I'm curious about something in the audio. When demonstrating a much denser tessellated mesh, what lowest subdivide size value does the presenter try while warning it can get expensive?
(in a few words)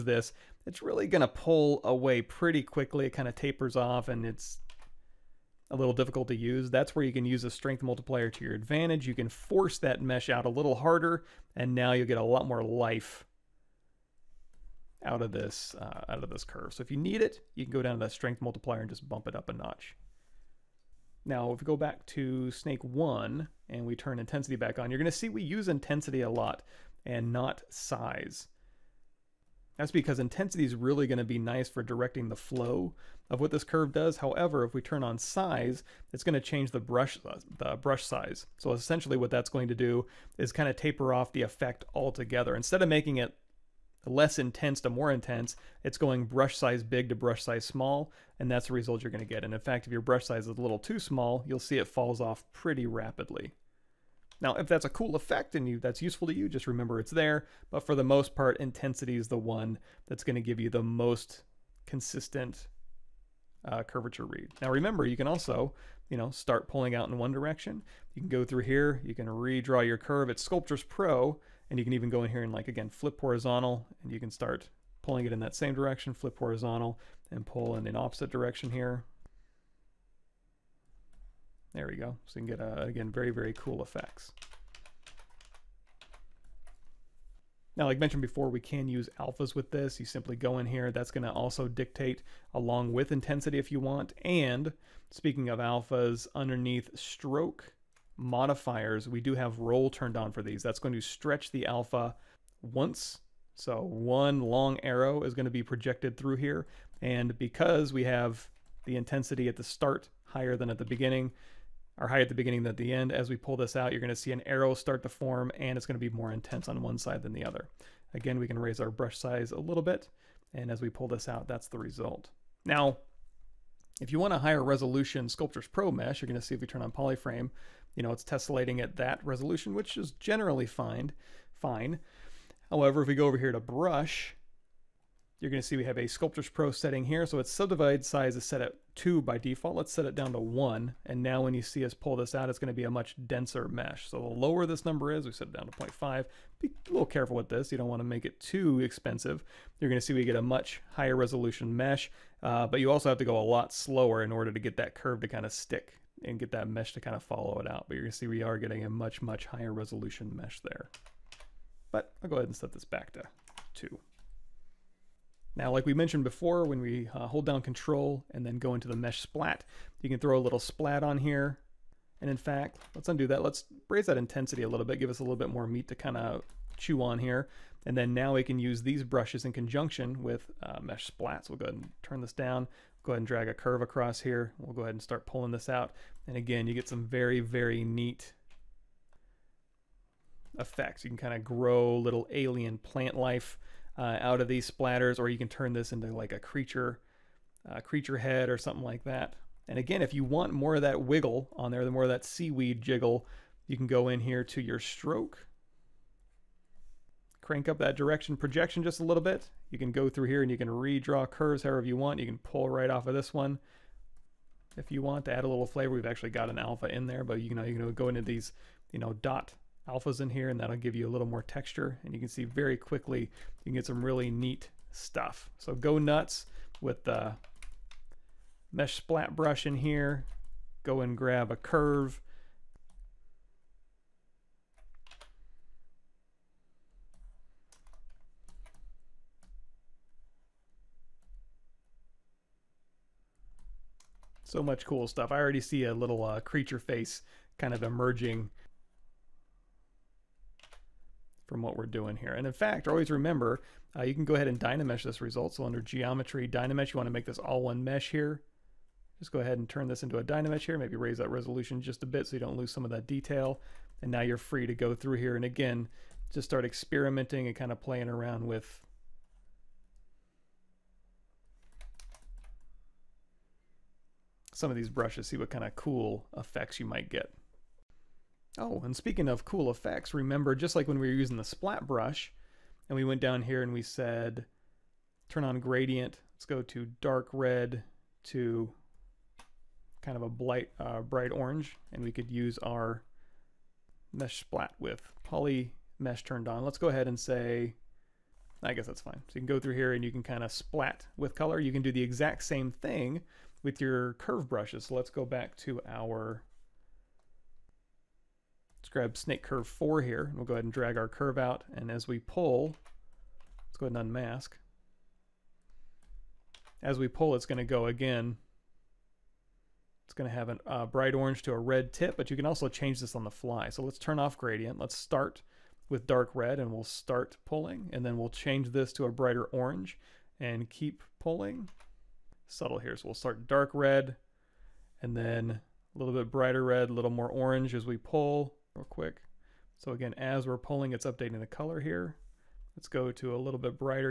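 0.5.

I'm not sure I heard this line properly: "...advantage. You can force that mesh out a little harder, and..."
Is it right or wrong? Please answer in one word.
right.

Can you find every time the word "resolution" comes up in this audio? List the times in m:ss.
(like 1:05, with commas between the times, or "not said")
2:04, 2:09, 2:31, 2:39, 4:21.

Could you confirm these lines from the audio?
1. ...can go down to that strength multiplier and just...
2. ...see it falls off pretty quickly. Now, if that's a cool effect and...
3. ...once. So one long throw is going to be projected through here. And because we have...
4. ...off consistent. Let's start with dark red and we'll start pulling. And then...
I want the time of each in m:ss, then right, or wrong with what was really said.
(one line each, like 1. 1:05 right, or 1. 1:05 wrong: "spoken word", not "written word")
1. 0:17 right
2. 0:51 wrong: "rapidly", not "quickly"
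3. 1:42 wrong: "arrow", not "throw"
4. 5:24 wrong: "gradient", not "consistent".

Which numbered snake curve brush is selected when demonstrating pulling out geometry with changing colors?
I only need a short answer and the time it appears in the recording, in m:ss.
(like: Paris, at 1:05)
Snake curve 4, at 5:09.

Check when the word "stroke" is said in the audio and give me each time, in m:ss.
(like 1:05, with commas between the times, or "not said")
1:36, 3:24.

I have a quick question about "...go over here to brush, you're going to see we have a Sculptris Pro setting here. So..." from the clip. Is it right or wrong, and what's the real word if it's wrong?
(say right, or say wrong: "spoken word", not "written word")
right.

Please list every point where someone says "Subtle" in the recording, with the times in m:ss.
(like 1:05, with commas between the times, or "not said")
5:32.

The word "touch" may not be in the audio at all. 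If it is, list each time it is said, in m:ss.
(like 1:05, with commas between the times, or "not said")
not said.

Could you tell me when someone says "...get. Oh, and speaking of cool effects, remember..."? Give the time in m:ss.
4:37.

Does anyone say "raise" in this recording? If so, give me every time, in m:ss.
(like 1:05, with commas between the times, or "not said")
1:58, 2:53, 4:20.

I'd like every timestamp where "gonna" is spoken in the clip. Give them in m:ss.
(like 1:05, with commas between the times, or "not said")
0:24.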